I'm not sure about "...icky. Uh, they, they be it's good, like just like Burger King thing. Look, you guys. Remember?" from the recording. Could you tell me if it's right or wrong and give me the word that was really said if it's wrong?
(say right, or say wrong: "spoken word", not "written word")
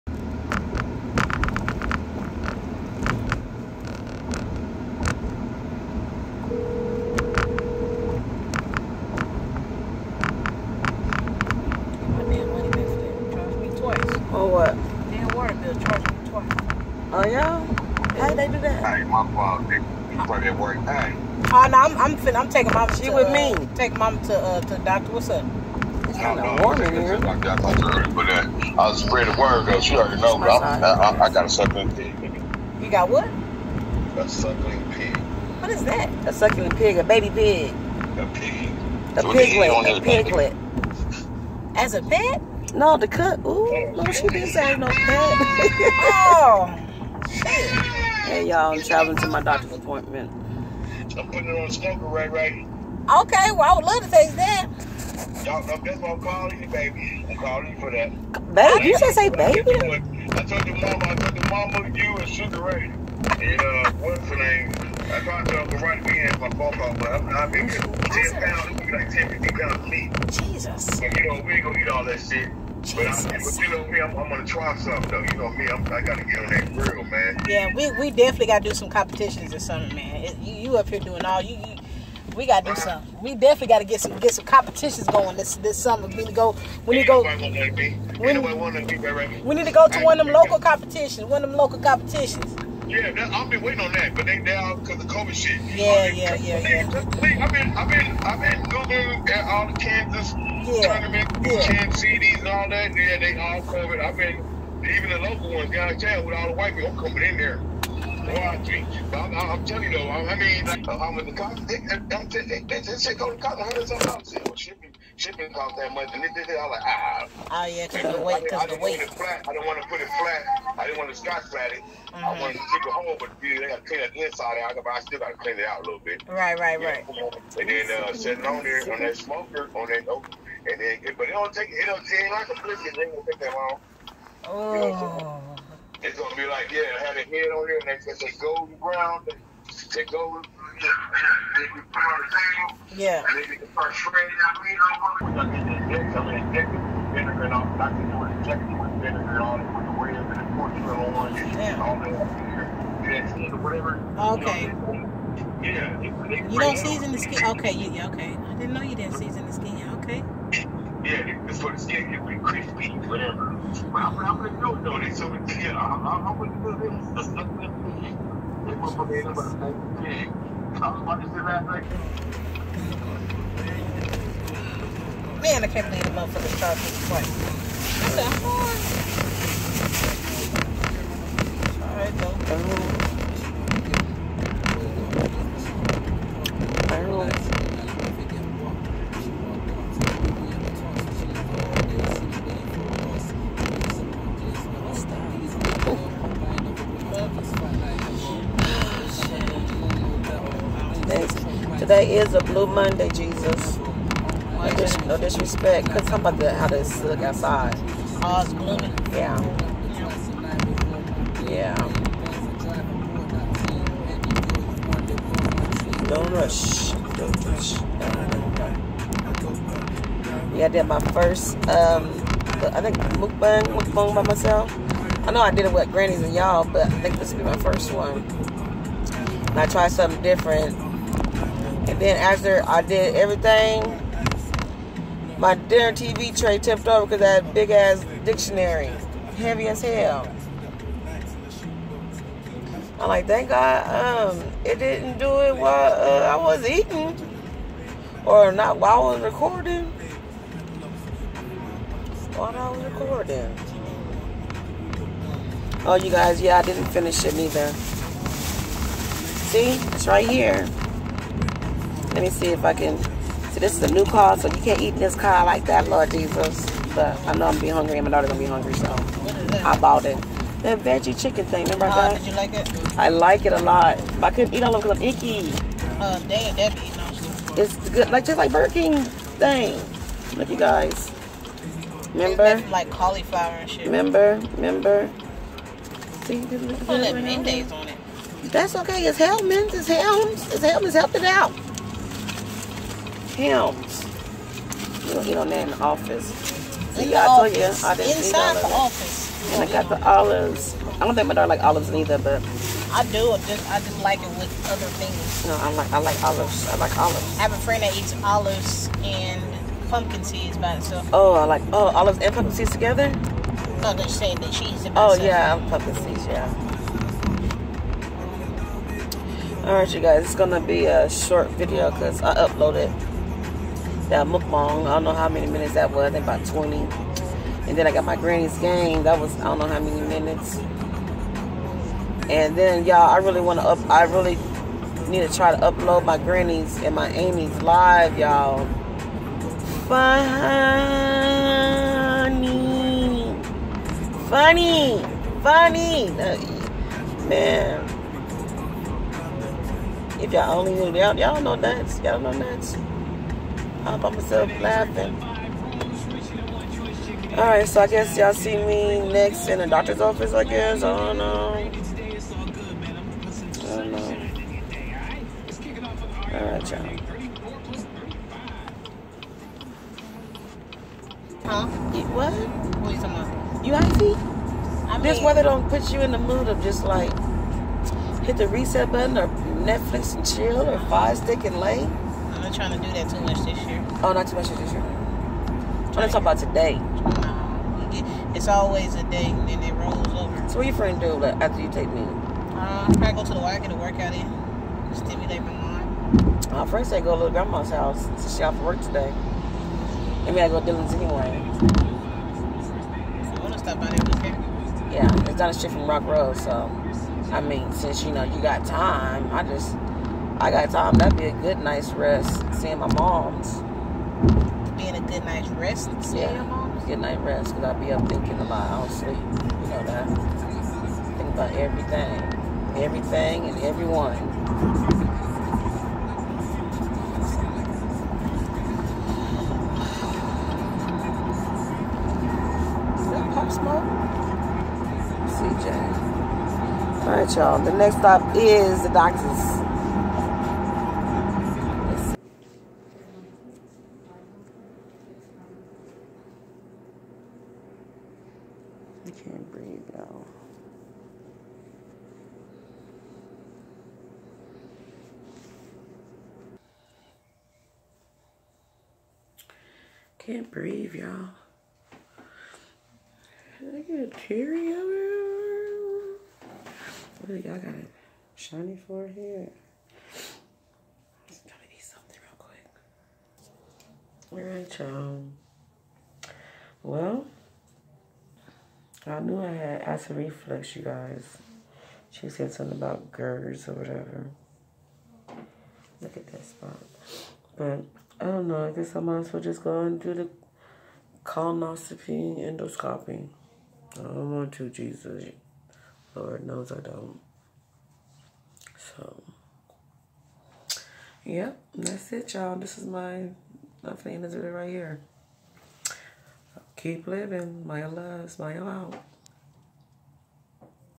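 right.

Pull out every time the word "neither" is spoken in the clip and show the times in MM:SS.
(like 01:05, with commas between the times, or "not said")
04:17, 05:01.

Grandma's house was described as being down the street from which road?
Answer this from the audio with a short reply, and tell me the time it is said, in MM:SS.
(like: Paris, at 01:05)
Rock Road, at 06:45.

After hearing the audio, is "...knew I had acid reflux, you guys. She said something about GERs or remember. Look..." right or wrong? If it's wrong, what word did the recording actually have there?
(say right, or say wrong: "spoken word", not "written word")
wrong: "whatever", not "remember".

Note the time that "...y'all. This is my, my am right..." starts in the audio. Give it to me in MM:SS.
08:22.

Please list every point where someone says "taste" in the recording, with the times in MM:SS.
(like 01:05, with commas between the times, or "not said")
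00:54.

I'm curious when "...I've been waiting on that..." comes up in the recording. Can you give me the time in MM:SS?
01:33.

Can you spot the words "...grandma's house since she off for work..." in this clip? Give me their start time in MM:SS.
06:37.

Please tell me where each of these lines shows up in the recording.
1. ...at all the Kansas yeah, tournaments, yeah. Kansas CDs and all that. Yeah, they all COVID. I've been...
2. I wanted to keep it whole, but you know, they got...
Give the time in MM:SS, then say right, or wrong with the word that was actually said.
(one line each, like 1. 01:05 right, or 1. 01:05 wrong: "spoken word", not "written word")
1. 01:39 right
2. 02:02 right.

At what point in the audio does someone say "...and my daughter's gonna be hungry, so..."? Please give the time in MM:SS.
04:27.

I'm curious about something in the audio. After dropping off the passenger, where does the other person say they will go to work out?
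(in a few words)
the Y.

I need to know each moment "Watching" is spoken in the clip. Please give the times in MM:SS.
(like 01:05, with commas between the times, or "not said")
01:48.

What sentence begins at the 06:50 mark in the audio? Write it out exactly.
That'd be a good nice rest.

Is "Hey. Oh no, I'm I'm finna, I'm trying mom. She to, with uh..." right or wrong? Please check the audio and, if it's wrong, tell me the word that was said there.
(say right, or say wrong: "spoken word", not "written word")
wrong: "taking", not "trying".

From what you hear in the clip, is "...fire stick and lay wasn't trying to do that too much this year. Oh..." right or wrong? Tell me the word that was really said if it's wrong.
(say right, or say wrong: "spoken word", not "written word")
right.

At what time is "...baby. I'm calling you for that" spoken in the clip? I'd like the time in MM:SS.
00:56.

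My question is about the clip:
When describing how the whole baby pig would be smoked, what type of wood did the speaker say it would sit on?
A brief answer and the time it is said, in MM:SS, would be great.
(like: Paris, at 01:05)
oak, at 02:10.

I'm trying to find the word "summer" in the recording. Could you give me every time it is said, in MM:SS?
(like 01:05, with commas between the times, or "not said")
01:19, 01:25.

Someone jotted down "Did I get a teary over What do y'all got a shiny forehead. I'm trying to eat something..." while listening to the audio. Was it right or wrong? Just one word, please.
right.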